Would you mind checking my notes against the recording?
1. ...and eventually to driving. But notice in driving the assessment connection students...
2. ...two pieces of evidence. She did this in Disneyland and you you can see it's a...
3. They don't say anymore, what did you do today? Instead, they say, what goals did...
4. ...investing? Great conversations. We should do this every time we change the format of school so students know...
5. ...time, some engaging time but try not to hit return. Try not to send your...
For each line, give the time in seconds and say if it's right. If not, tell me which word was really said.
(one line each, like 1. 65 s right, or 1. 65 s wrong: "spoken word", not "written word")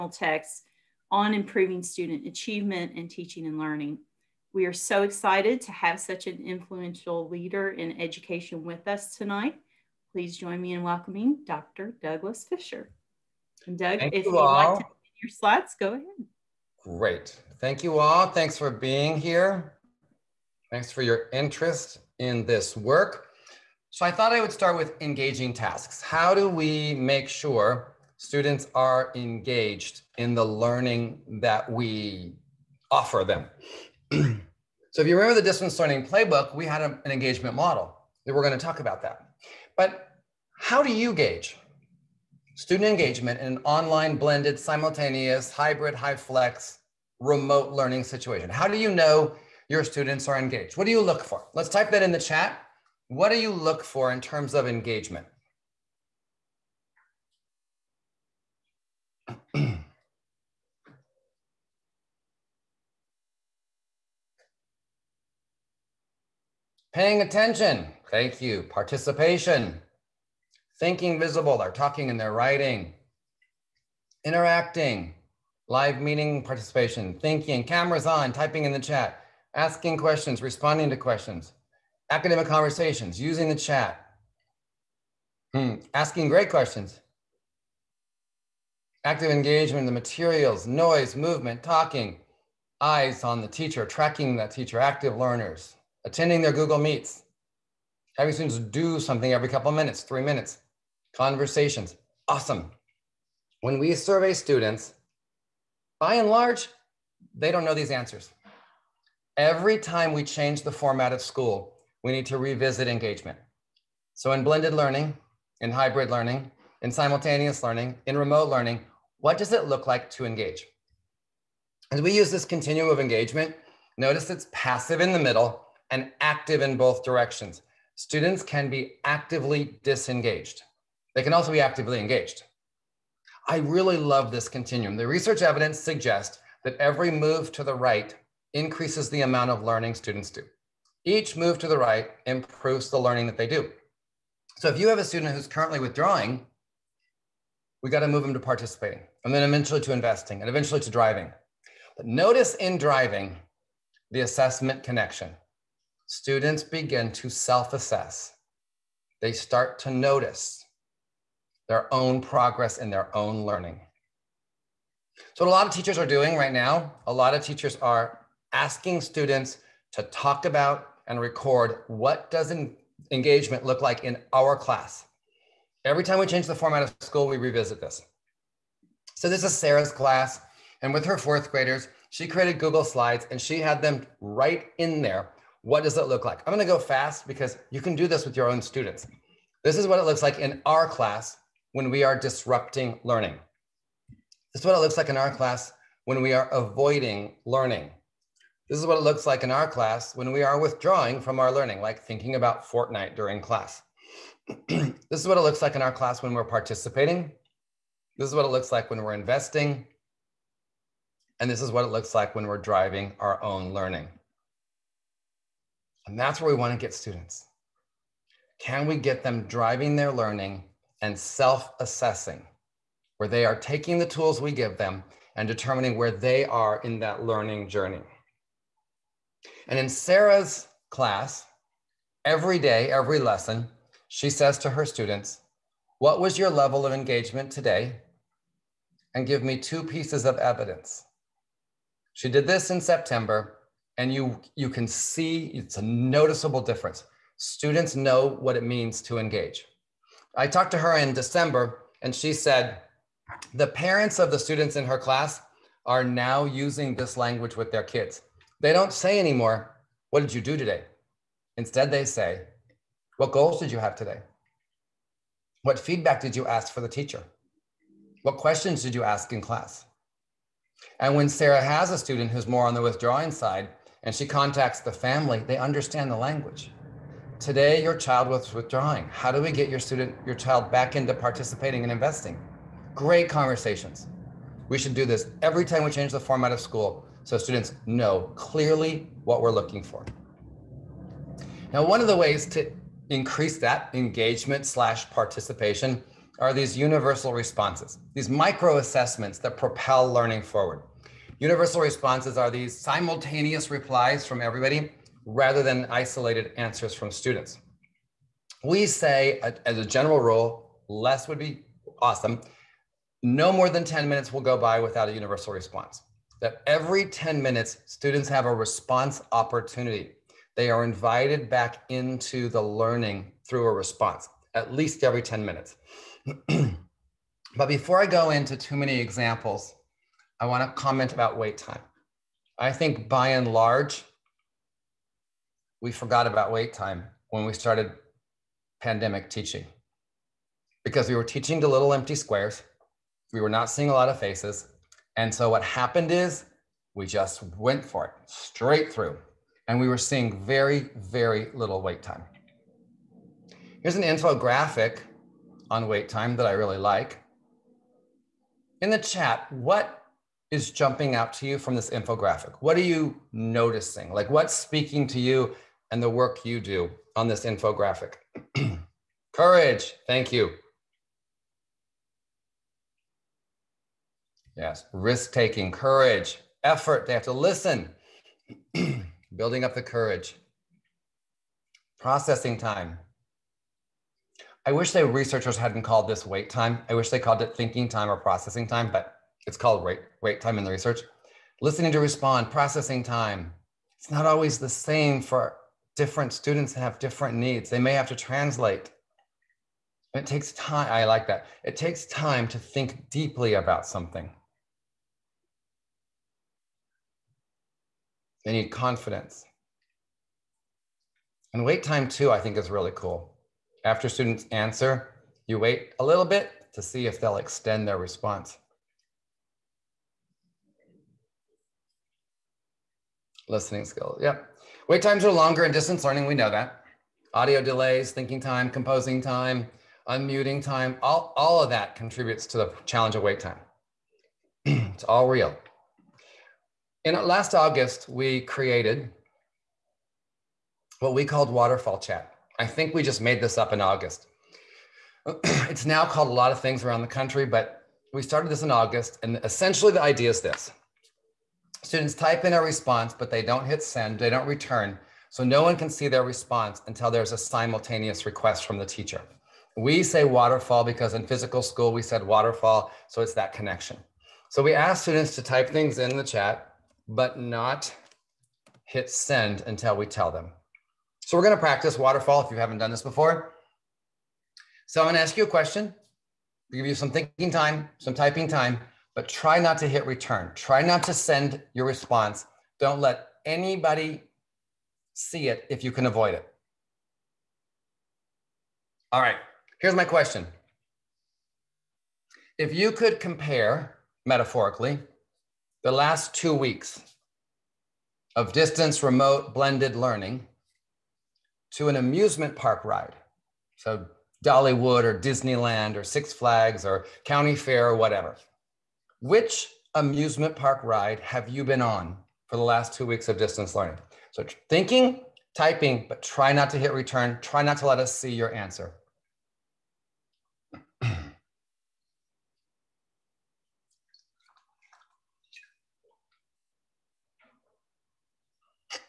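1. 150 s right
2. 239 s wrong: "September", not "Disneyland"
3. 258 s right
4. 281 s right
5. 477 s wrong: "typing", not "engaging".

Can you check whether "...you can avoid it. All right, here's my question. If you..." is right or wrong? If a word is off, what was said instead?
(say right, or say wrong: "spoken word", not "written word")
right.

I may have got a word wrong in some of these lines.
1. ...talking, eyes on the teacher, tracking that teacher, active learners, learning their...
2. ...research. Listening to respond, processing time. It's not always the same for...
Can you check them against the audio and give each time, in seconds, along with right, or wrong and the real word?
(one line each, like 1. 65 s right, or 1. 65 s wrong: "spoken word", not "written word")
1. 91 s wrong: "attending", not "learning"
2. 390 s right.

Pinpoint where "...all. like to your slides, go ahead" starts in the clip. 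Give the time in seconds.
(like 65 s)
14 s.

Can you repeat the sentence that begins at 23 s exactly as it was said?
So I thought I would start with engaging tasks.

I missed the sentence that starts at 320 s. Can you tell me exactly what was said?
They are invited back into the learning through a response, at least every 10 minutes.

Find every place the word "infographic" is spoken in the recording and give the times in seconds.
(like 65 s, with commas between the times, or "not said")
354 s, 361 s, 367 s.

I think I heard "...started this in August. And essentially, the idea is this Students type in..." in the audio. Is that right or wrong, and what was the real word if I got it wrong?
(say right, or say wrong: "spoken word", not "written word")
right.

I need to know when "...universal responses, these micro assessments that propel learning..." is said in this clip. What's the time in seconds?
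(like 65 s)
296 s.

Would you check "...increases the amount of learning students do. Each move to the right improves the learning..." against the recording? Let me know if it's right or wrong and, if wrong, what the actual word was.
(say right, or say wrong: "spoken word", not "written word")
right.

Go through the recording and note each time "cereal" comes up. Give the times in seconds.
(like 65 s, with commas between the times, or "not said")
not said.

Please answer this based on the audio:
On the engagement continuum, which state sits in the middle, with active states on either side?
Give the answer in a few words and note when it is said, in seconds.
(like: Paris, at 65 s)
Passive, at 124 s.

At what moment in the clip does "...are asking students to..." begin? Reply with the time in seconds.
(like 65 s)
167 s.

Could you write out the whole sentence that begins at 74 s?
Interacting, live meeting participation, thinking, cameras on, typing in the chat, asking questions, responding to questions, academic conversations, using the chat, hmm.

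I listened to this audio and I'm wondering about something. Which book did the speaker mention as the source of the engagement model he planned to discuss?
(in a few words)
The Distance Learning Playbook.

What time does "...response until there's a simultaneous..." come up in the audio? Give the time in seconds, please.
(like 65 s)
456 s.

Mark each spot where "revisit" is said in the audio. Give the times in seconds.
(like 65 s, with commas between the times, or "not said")
112 s, 177 s.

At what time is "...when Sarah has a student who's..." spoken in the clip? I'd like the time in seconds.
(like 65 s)
271 s.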